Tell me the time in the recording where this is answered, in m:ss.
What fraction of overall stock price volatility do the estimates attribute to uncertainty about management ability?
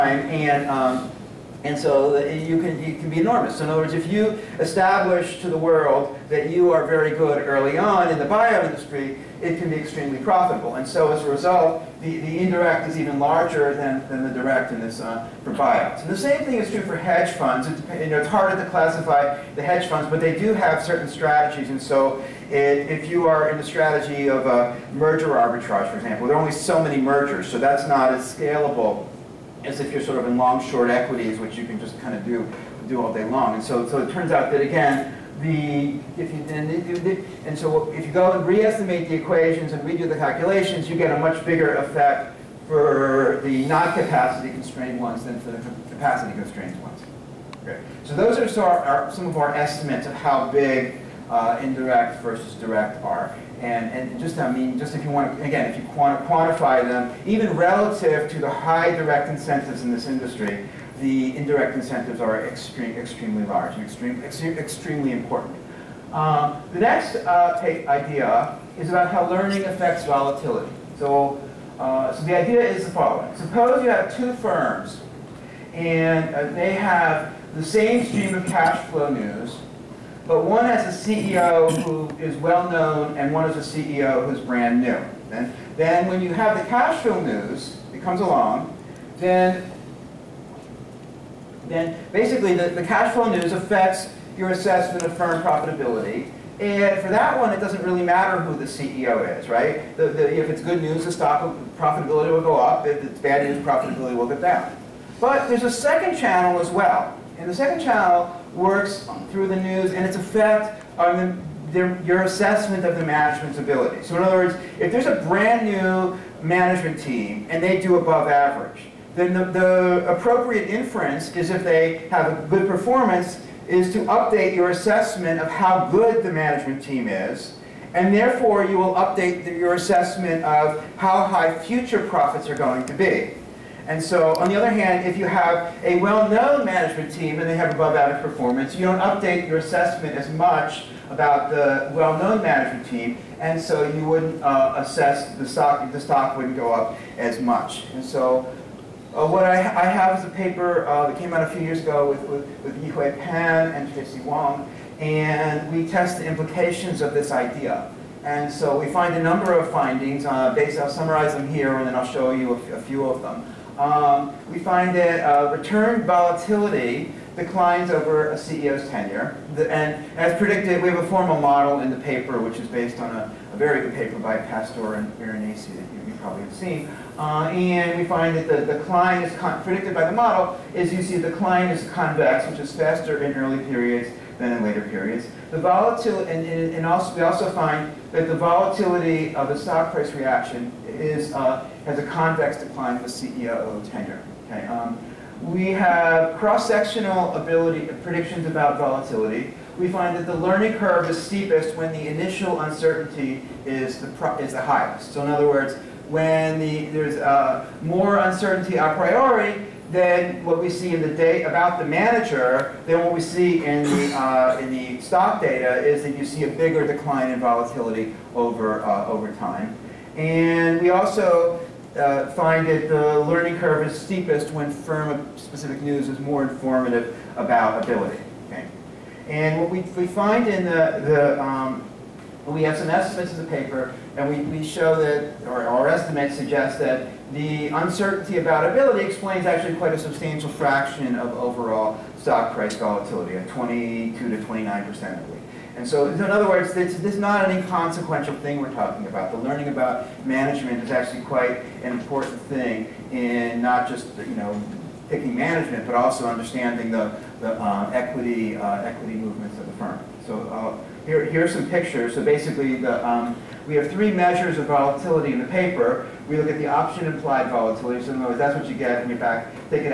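4:03.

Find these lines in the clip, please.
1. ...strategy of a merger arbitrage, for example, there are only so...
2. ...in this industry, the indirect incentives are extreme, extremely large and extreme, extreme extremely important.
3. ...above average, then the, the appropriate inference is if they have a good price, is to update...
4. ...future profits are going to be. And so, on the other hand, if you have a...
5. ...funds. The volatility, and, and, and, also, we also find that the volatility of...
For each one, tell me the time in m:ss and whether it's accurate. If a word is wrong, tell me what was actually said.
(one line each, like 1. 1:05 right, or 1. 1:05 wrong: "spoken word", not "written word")
1. 0:23 right
2. 0:59 right
3. 1:57 wrong: "performance", not "price"
4. 2:11 right
5. 3:04 wrong: "periods", not "funds".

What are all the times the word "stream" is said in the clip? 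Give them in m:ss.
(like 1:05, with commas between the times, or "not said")
1:18.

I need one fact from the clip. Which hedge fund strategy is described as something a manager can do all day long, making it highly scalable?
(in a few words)
long short equities.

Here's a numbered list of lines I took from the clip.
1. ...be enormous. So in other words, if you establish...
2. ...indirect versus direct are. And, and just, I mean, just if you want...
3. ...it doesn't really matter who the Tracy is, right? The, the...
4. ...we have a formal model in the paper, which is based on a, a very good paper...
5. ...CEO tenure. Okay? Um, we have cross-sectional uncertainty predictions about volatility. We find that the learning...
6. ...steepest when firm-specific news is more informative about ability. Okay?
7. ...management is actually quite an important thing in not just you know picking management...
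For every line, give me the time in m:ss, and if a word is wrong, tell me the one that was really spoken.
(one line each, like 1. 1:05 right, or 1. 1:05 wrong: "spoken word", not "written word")
1. 0:03 right
2. 0:51 right
3. 1:37 wrong: "CEO", not "Tracy"
4. 2:50 right
5. 3:13 wrong: "ability", not "uncertainty"
6. 3:43 right
7. 4:10 right.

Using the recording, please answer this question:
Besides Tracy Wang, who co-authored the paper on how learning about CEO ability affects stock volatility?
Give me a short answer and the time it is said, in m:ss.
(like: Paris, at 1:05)
Yihui Pan, at 2:32.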